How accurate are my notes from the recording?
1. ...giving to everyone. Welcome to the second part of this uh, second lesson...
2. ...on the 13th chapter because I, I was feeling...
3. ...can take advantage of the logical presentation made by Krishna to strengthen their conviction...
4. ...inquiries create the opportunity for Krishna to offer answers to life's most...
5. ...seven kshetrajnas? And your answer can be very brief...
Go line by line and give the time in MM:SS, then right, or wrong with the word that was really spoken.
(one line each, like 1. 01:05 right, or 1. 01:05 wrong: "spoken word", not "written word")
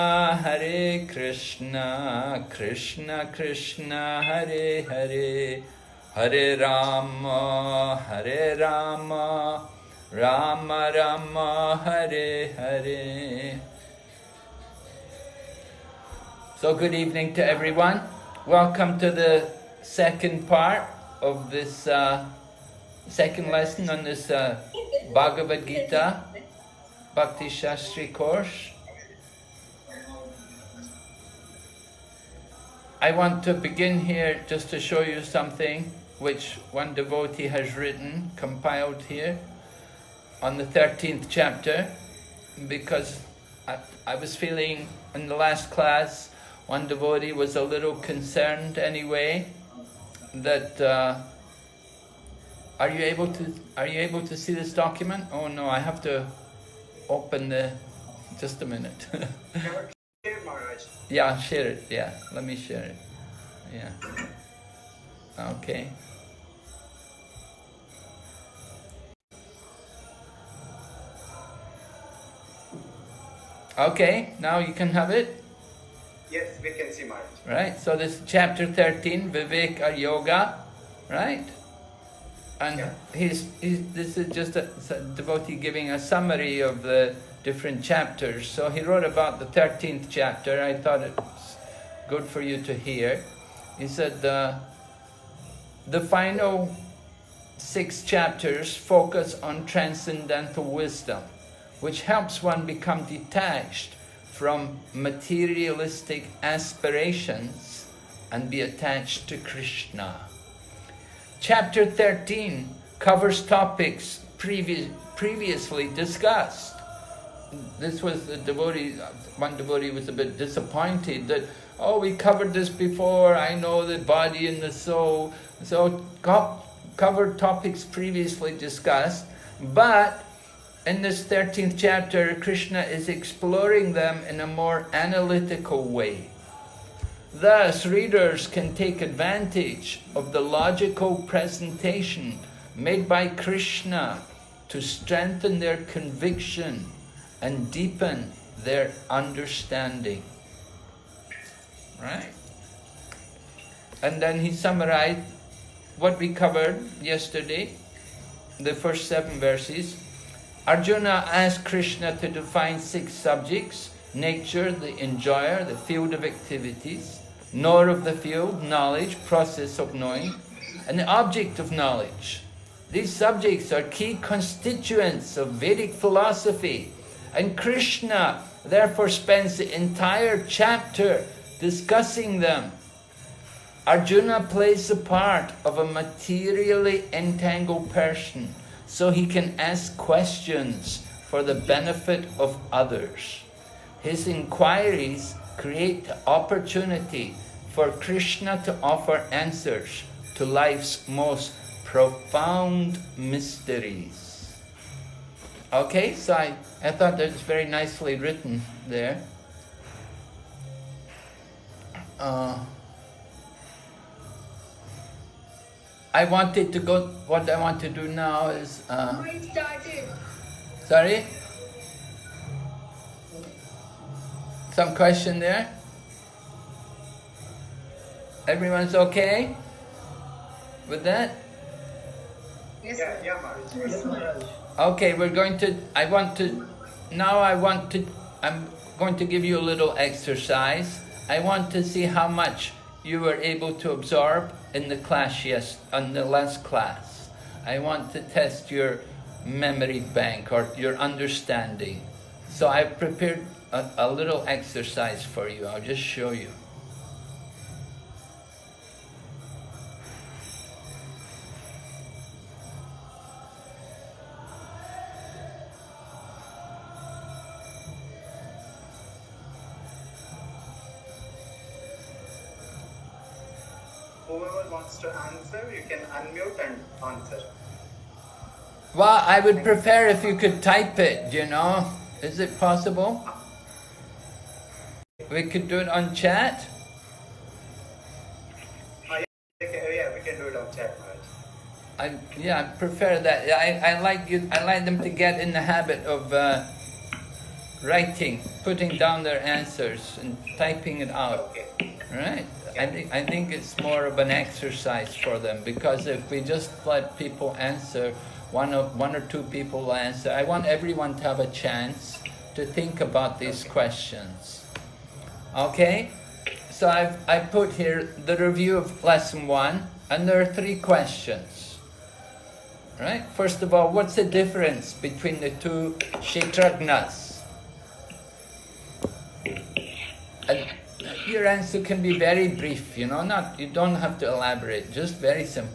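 1. 00:16 wrong: "evening", not "giving"
2. 00:40 right
3. 02:18 right
4. 03:14 right
5. 05:25 wrong: "two", not "seven".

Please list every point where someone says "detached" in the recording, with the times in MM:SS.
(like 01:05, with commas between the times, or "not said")
01:43.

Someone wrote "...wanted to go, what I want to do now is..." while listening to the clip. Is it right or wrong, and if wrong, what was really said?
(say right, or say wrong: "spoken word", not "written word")
right.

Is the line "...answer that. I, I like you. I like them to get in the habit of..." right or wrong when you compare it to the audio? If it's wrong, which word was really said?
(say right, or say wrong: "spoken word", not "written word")
wrong: "prefer", not "answer".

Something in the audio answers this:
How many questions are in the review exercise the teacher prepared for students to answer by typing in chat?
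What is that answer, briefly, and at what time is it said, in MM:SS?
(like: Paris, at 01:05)
3, at 05:20.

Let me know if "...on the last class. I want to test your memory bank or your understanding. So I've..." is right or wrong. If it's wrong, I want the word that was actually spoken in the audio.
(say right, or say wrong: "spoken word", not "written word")
right.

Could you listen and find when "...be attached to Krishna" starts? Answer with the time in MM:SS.
01:48.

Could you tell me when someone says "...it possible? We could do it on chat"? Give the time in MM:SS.
04:42.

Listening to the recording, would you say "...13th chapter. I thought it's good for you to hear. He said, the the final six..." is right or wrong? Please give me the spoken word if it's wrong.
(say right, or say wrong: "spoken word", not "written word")
right.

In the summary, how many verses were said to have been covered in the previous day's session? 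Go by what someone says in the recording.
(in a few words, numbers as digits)
7.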